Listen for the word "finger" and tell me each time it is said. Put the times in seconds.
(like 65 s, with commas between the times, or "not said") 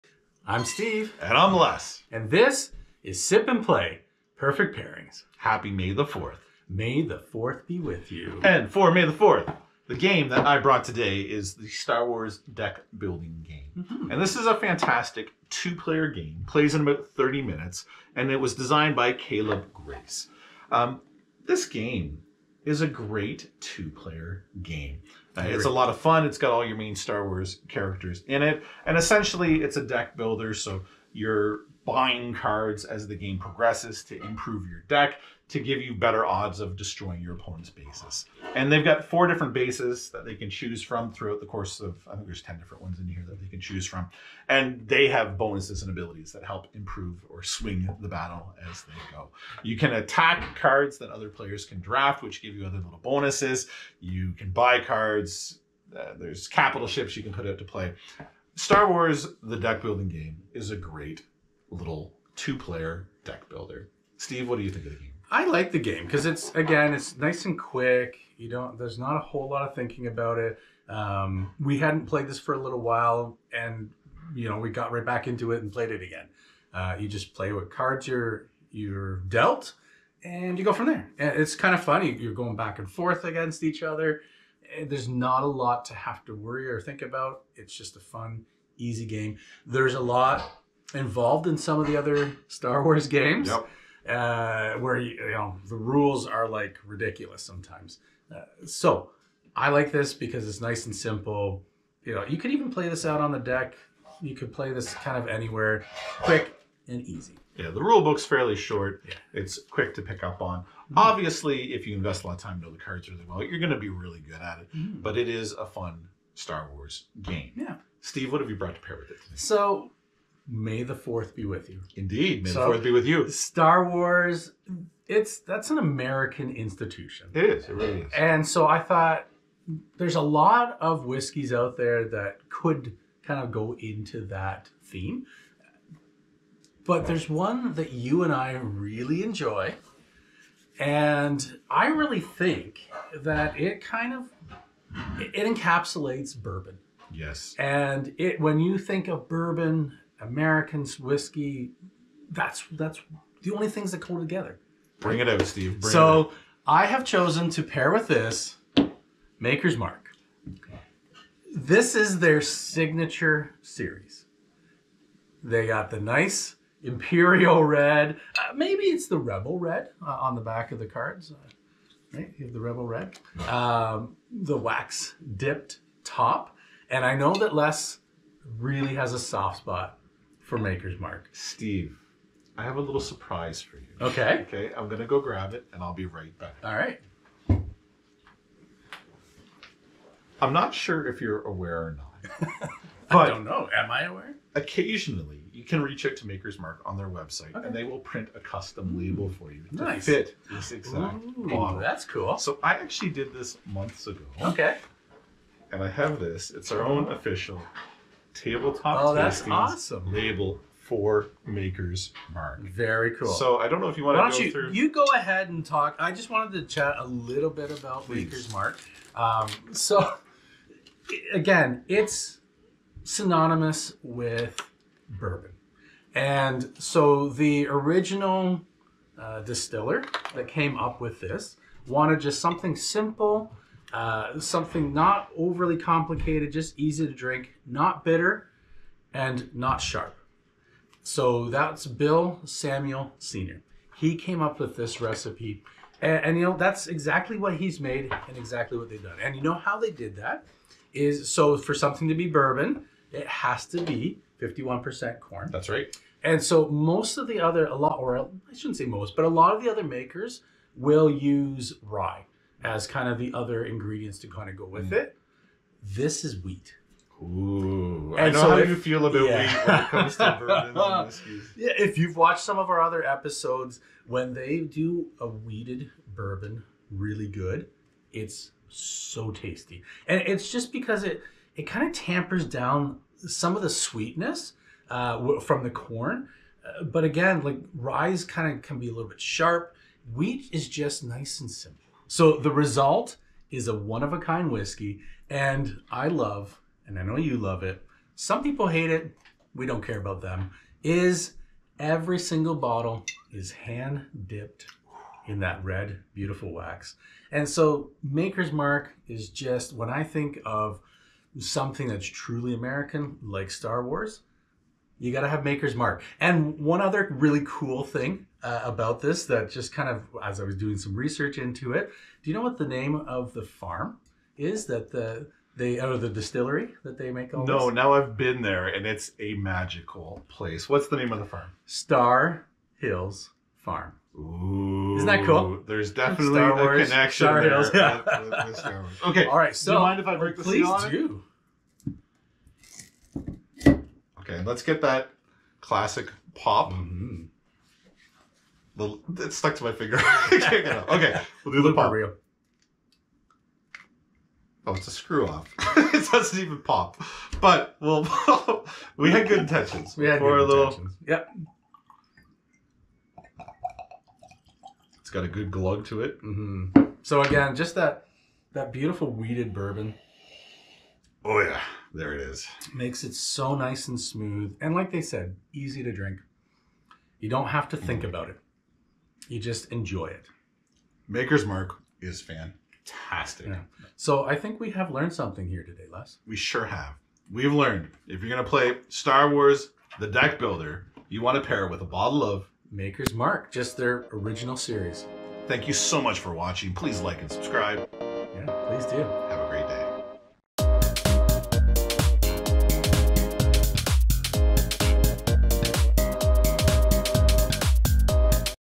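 349 s.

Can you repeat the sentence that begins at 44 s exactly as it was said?
And they have bonuses and abilities that help improve or swing the battle as they go.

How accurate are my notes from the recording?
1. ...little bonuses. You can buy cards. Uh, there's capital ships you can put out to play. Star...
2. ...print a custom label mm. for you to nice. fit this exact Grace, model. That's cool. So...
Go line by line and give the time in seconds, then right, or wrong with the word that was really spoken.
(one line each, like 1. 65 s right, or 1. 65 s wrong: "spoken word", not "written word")
1. 52 s right
2. 197 s wrong: "Ooh", not "Grace".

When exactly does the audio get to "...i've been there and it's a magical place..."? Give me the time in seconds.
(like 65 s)
327 s.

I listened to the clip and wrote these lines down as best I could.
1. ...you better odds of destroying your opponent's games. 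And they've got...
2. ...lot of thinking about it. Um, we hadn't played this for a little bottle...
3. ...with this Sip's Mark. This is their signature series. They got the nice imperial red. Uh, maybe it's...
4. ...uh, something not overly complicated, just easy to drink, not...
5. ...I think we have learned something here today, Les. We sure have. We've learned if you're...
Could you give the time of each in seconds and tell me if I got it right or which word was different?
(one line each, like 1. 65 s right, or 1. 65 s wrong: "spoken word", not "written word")
1. 35 s wrong: "bases", not "games"
2. 69 s wrong: "while", not "bottle"
3. 157 s wrong: "Maker", not "Sip"
4. 233 s right
5. 384 s right.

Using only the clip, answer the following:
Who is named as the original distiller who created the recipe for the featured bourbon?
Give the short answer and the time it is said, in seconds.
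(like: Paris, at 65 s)
Bill Samuels Sr., at 241 s.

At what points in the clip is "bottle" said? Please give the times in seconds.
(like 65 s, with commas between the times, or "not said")
302 s, 391 s.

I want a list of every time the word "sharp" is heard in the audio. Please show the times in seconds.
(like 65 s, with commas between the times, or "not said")
239 s, 289 s.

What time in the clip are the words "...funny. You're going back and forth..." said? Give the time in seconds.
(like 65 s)
81 s.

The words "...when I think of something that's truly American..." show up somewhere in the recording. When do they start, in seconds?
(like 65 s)
309 s.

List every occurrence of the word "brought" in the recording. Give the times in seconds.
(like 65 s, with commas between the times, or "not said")
10 s, 118 s.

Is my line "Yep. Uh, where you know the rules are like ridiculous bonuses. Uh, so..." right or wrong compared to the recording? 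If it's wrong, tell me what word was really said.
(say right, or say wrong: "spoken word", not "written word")
wrong: "sometimes", not "bonuses".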